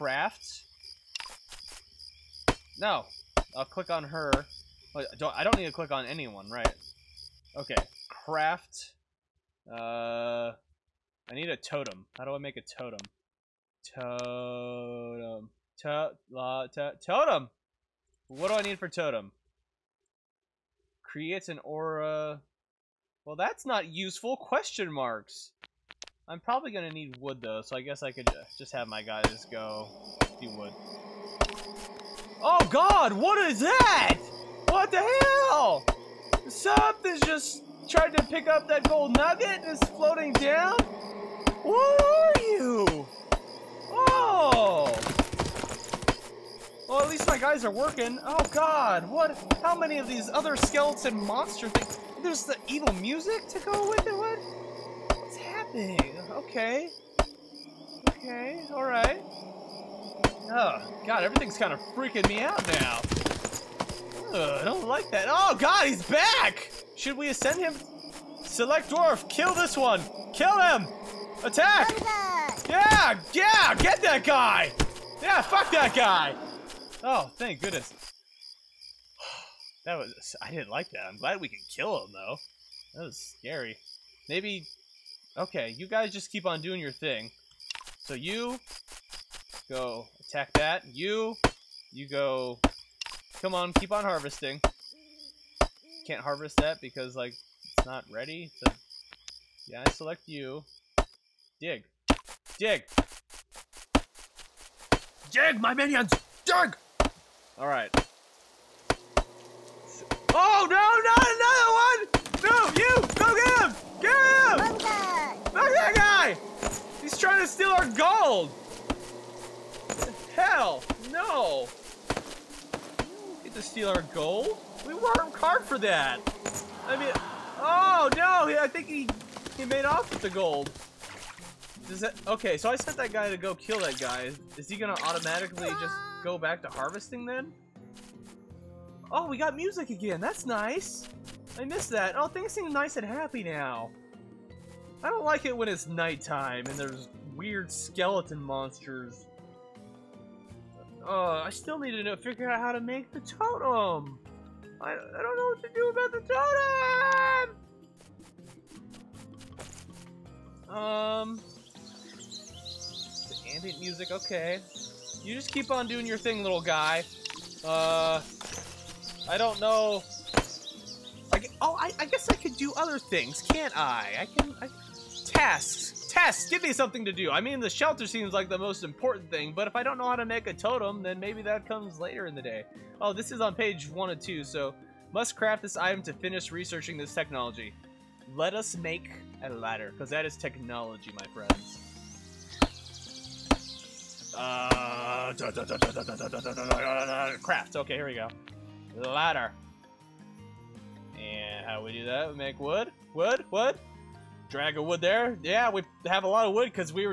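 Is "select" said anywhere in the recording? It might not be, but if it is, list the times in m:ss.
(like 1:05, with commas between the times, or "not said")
1:08, 1:39.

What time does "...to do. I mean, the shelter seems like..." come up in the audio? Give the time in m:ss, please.
2:57.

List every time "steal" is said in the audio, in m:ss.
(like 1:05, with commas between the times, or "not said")
1:57, 2:03.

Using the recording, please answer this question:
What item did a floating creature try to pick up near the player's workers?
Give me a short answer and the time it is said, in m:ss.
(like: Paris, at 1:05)
Gold nugget, at 0:38.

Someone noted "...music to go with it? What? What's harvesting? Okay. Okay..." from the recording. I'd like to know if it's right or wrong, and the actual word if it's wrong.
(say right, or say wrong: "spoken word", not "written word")
wrong: "happening", not "harvesting".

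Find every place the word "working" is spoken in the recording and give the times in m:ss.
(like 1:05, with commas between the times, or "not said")
0:47.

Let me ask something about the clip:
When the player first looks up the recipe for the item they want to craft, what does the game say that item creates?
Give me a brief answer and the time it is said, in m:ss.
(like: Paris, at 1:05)
An aura, at 0:21.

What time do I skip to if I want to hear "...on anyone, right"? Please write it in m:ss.
0:05.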